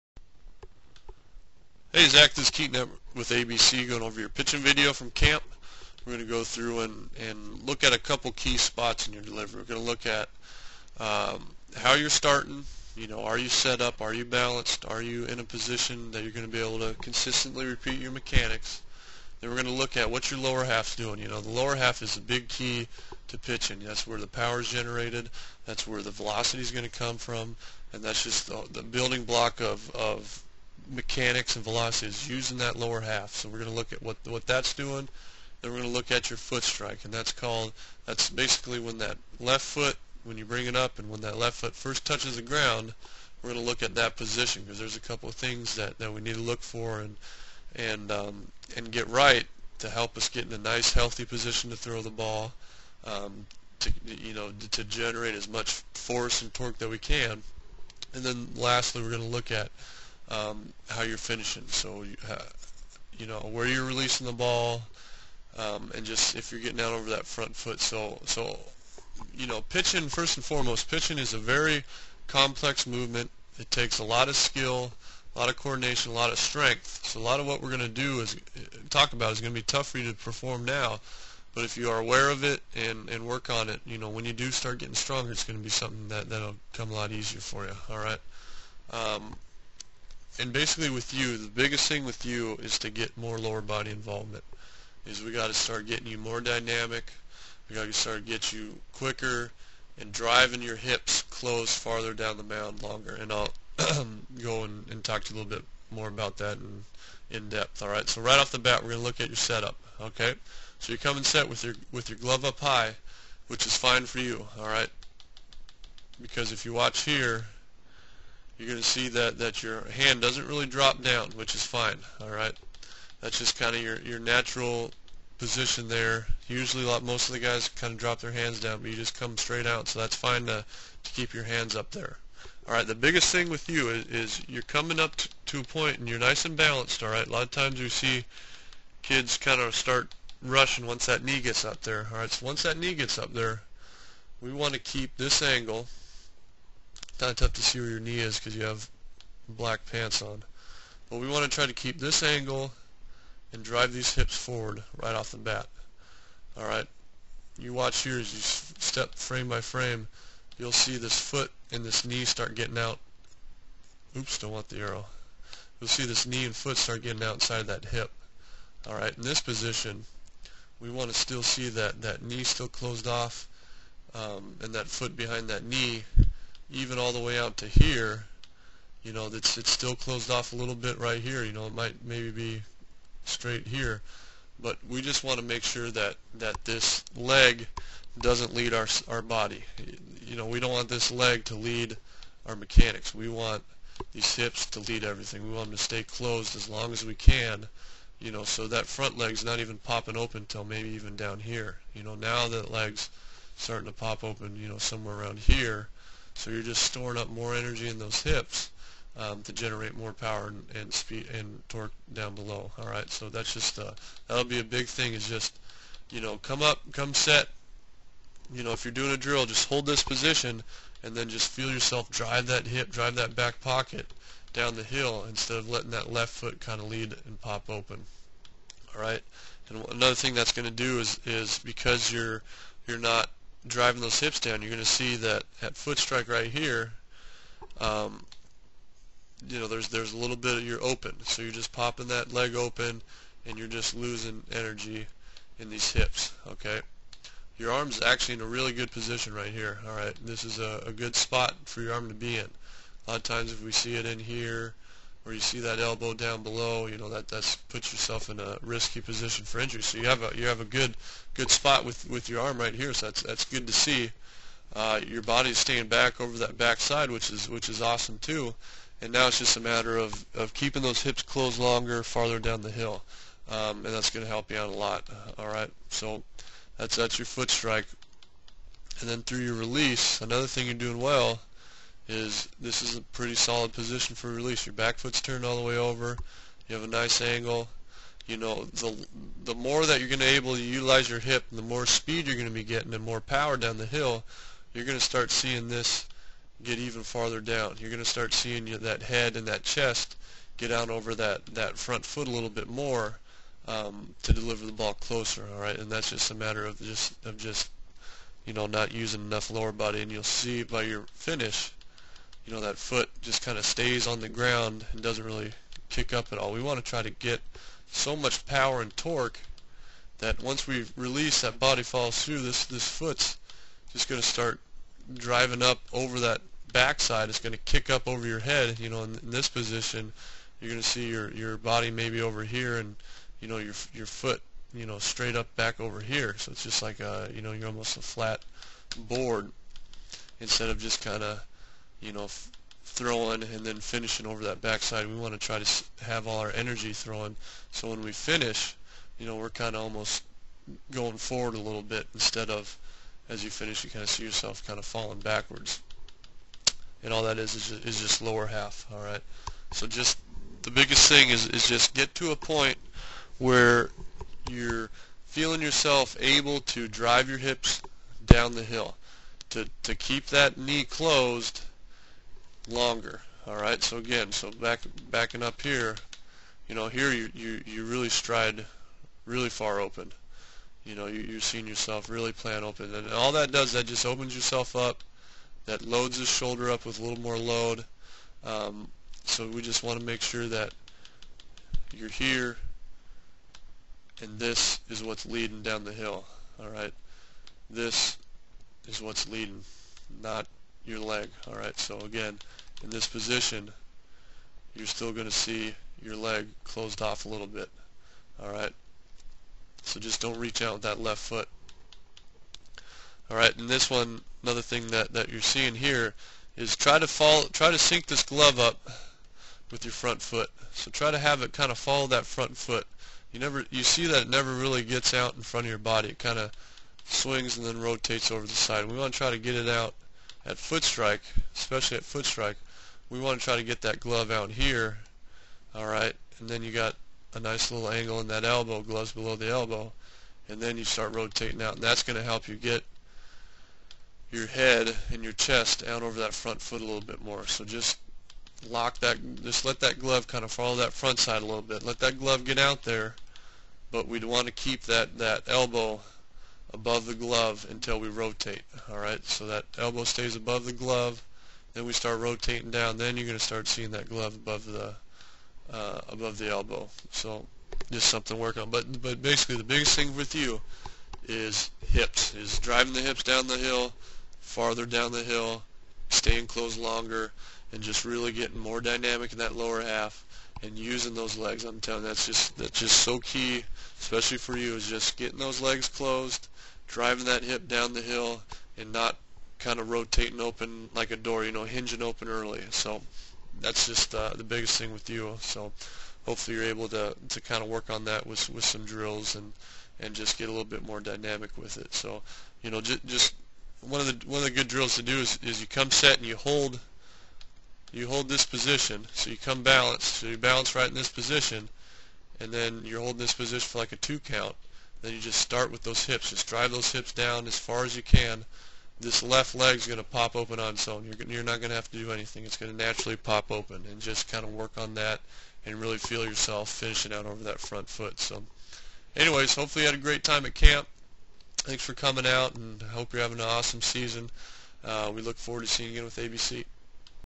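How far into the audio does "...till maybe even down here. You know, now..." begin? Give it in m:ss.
3:20.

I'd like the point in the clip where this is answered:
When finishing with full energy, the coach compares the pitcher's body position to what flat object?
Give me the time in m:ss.
5:38.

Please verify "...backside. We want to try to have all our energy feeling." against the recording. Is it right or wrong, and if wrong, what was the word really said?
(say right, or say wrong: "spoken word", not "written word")
wrong: "throwing", not "feeling".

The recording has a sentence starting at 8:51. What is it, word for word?
Thanks for coming out, and I hope you're having an awesome season.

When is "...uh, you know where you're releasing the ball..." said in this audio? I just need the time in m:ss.
1:02.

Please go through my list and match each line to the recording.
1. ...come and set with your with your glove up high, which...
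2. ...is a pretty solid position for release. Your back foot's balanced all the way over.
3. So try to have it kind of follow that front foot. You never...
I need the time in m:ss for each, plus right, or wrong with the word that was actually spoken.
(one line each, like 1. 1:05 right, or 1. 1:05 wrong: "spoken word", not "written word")
1. 1:50 right
2. 4:42 wrong: "turned", not "balanced"
3. 7:00 right.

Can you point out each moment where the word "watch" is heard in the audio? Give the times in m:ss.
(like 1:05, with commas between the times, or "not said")
1:56, 2:37.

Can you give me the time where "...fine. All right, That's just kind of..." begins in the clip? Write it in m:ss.
2:01.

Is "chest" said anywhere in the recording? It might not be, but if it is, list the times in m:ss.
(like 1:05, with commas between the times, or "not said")
4:59, 7:25.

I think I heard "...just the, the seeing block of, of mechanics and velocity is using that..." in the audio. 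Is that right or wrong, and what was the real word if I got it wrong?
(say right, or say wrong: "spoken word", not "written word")
wrong: "building", not "seeing".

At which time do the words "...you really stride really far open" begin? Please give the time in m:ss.
6:17.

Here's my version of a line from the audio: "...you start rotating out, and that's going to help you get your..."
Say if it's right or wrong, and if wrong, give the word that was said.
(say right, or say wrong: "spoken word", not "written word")
right.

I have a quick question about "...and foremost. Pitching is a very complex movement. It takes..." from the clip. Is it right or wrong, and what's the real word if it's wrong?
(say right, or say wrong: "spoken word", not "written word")
right.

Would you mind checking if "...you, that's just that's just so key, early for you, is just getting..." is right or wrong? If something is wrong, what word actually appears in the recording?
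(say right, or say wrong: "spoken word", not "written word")
wrong: "especially", not "early".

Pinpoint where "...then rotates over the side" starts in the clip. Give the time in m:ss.
7:07.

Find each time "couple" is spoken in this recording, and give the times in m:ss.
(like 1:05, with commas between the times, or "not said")
0:07, 0:45.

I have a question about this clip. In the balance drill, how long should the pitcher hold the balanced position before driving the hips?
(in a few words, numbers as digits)
2 count.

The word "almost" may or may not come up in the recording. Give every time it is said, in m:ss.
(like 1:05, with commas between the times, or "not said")
5:37, 5:49.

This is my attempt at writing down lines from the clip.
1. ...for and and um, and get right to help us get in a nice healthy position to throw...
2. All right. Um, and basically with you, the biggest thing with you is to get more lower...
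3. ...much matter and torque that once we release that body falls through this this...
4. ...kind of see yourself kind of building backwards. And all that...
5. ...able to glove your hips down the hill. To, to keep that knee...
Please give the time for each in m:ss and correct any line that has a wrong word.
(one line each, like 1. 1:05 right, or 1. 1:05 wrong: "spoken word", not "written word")
1. 0:46 right
2. 1:27 right
3. 5:18 wrong: "power", not "matter"
4. 5:53 wrong: "falling", not "building"
5. 6:06 wrong: "drive", not "glove".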